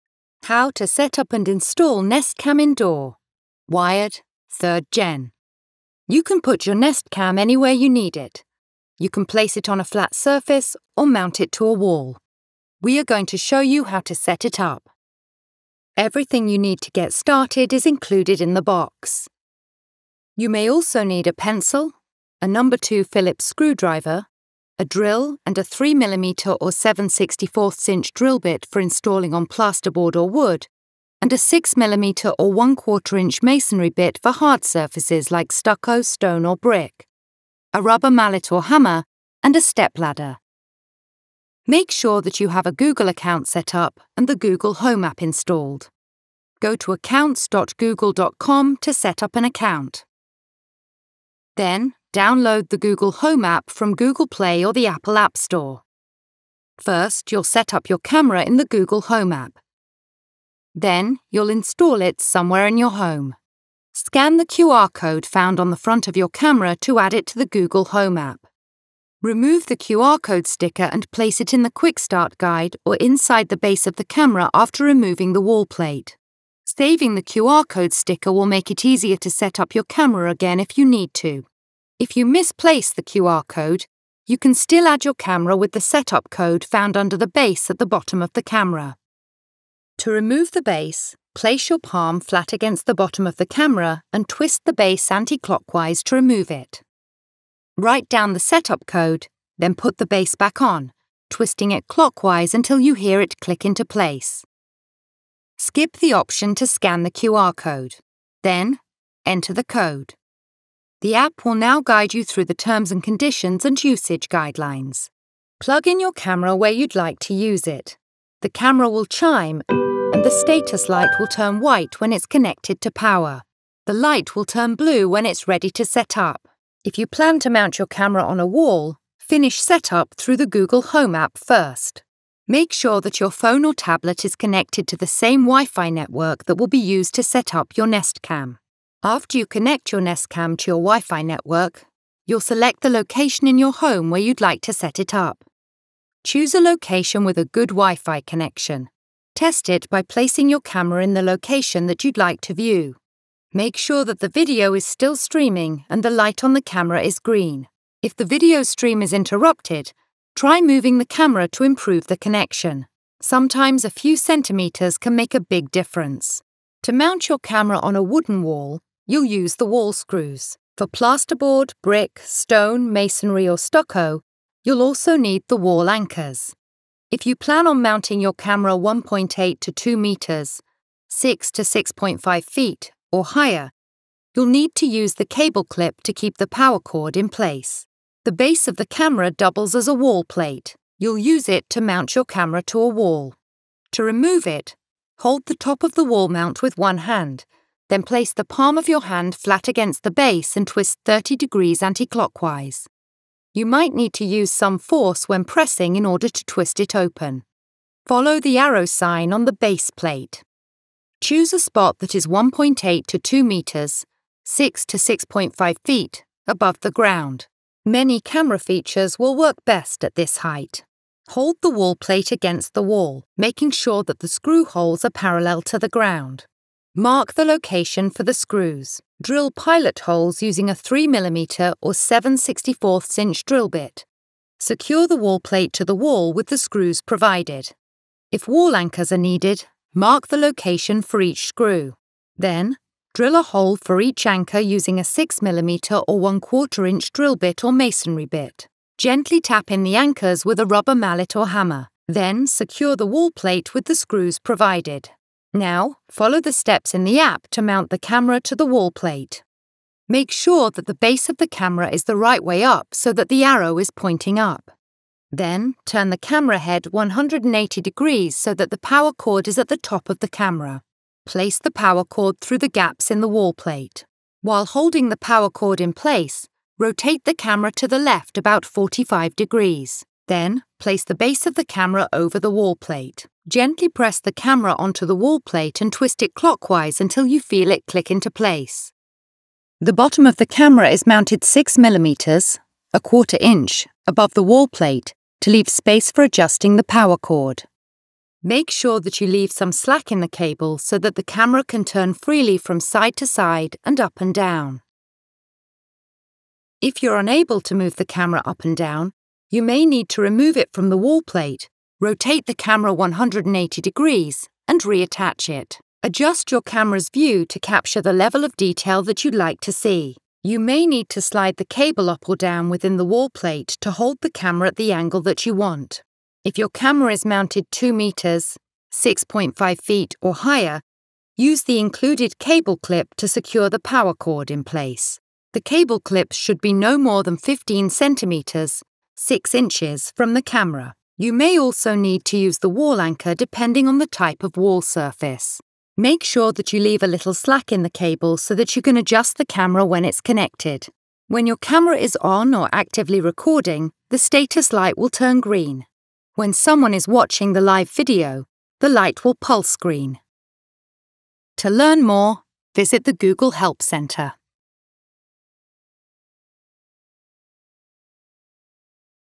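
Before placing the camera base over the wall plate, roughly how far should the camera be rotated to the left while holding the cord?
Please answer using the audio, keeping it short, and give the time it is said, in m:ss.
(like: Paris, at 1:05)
45 degrees, at 4:38.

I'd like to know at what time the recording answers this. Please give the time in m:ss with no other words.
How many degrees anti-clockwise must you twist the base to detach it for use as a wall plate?
3:21.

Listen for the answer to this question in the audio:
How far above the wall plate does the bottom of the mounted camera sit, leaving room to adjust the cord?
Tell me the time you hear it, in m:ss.
4:51.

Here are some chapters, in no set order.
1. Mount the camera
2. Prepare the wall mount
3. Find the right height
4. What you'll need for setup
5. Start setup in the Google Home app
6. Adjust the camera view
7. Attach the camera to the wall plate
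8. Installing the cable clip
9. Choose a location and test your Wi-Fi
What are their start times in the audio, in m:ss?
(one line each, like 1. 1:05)
1. 3:14
2. 2:46
3. 2:56
4. 0:15
5. 0:41
6. 5:15
7. 3:41
8. 5:26
9. 2:11.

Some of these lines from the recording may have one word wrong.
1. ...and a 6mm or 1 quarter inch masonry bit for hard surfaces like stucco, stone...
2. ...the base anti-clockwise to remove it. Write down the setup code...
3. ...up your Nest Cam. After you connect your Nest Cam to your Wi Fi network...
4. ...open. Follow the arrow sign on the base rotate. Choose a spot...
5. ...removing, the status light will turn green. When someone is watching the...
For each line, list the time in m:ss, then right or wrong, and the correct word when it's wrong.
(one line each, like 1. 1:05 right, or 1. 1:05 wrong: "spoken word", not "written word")
1. 0:31 right
2. 1:34 right
3. 2:17 right
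4. 3:26 wrong: "plate", not "rotate"
5. 5:53 wrong: "recording", not "removing".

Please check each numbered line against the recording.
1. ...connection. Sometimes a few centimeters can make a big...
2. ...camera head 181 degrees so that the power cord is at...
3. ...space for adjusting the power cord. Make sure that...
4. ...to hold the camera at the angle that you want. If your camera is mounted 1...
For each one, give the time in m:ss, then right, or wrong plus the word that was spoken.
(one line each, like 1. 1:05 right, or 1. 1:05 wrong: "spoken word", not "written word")
1. 2:42 right
2. 4:26 wrong: "180", not "181"
3. 4:55 right
4. 5:23 wrong: "2", not "1".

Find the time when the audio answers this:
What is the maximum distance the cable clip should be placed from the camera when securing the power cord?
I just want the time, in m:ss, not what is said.
5:37.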